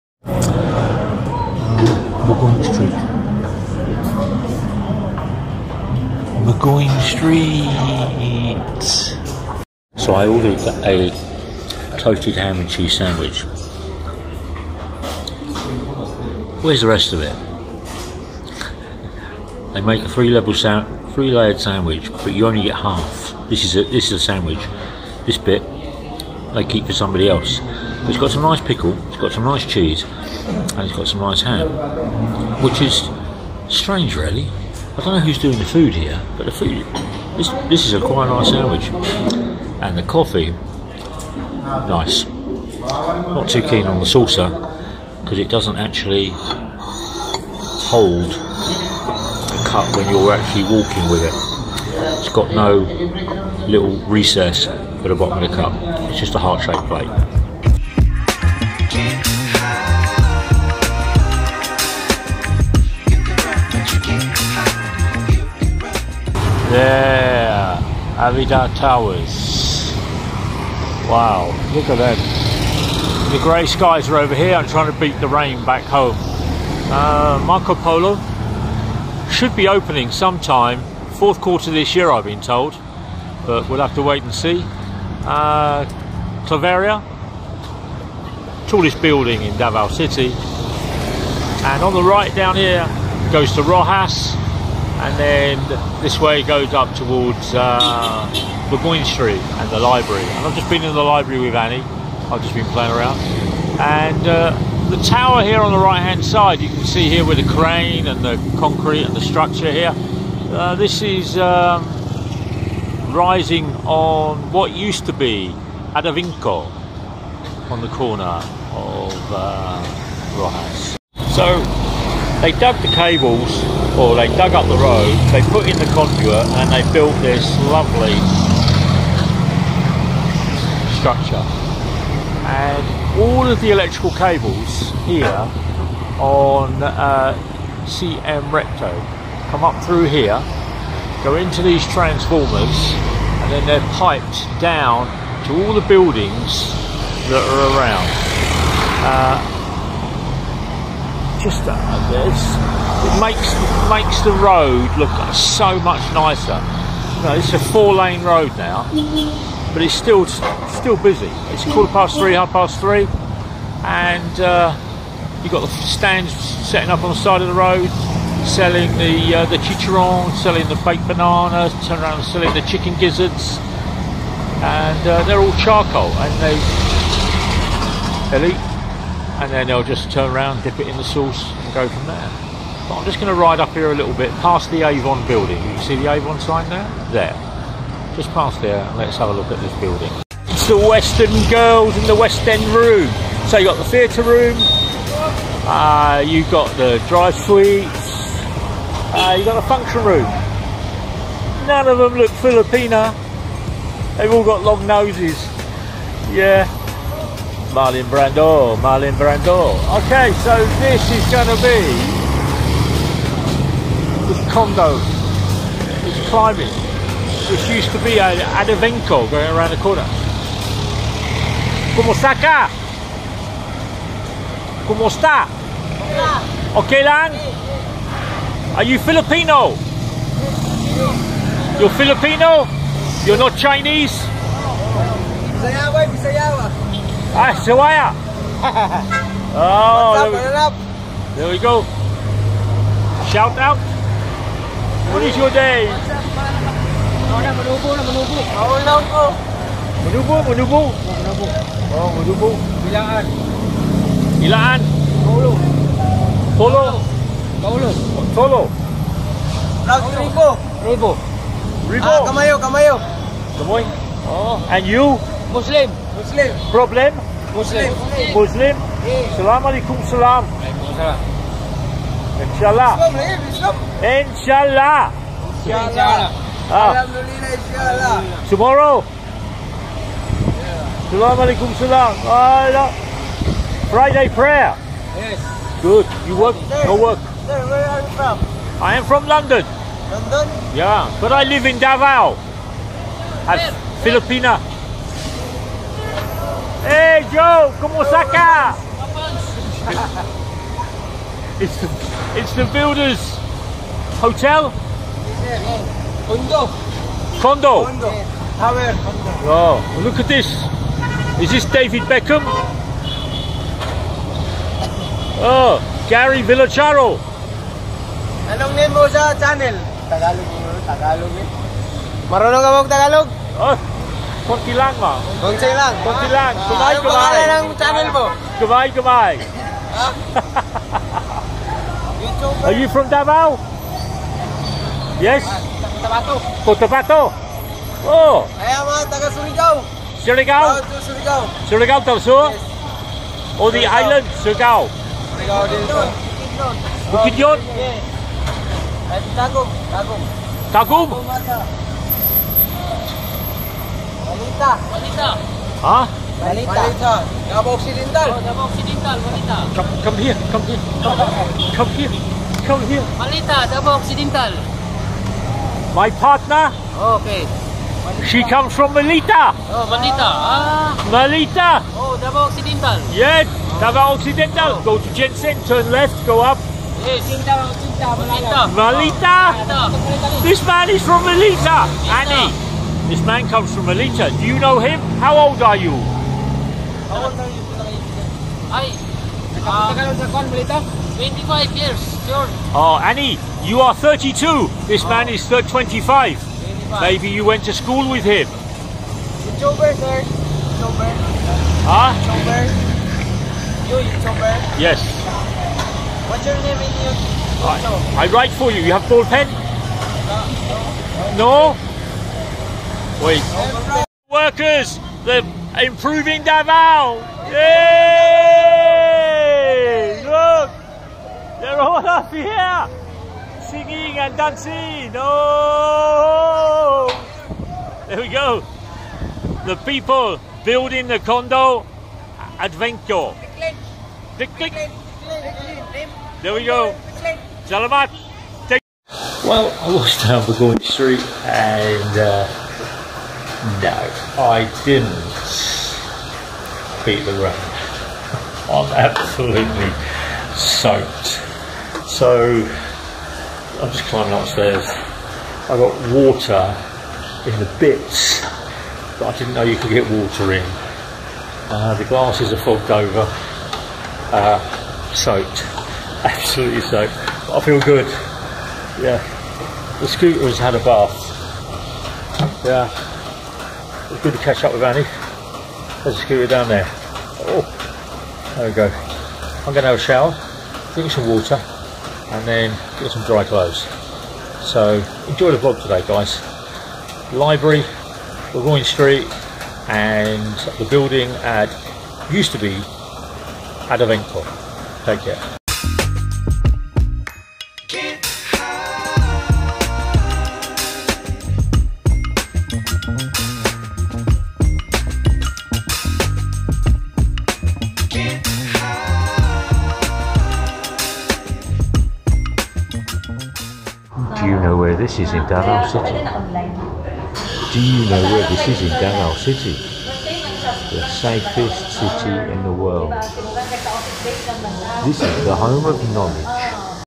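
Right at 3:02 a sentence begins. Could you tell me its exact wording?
But I'm just going to ride up here a little bit past the Avon building.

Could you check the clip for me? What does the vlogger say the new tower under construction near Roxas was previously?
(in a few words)
Adavinco.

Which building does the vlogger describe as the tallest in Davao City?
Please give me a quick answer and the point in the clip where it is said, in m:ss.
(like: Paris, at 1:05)
Claveria, at 1:26.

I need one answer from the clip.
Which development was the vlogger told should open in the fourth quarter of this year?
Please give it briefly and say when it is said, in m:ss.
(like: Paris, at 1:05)
Marco Polo, at 1:17.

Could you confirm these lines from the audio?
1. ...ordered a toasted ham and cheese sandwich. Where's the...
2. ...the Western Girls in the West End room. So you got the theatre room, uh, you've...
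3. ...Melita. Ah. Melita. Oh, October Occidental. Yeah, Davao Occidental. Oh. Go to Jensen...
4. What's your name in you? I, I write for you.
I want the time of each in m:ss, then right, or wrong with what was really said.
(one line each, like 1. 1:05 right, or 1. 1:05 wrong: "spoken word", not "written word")
1. 0:10 right
2. 3:10 right
3. 6:09 wrong: "Davao", not "October"
4. 6:46 right.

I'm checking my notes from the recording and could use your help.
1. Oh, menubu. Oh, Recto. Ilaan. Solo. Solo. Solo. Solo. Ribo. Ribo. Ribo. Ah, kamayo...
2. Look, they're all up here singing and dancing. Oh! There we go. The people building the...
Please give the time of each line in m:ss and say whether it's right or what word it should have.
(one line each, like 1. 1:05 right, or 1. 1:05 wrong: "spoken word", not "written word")
1. 4:11 wrong: "Ilaan", not "Recto"
2. 7:00 right.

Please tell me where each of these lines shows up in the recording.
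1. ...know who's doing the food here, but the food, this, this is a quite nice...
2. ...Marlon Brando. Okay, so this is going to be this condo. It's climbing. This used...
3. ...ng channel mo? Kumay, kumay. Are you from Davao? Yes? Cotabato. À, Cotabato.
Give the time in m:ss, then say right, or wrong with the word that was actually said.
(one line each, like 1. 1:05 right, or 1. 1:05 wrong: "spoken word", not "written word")
1. 0:35 right
2. 3:28 right
3. 5:27 right.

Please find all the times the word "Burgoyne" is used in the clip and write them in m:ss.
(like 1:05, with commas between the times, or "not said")
1:38, 8:08.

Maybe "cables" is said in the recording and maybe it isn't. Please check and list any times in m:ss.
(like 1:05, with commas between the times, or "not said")
2:02, 2:14.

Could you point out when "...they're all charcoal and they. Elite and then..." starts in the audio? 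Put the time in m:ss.
2:55.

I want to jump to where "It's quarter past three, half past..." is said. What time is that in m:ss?
2:41.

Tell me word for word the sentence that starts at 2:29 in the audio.
Uh, just it's, it makes it makes the road look so much nicer.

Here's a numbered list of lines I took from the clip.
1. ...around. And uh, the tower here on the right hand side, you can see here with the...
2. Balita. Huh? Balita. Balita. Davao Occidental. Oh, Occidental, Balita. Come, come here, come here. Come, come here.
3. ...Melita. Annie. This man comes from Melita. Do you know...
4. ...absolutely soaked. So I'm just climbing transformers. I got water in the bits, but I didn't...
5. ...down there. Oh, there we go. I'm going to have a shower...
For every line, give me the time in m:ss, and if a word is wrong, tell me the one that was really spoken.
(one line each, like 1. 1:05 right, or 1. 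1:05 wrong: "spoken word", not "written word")
1. 1:42 right
2. 5:54 right
3. 6:21 right
4. 7:28 wrong: "upstairs", not "transformers"
5. 7:56 right.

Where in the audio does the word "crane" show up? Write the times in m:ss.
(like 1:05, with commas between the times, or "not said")
1:47.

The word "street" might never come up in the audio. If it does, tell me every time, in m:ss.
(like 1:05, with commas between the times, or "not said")
1:39, 7:20, 8:08.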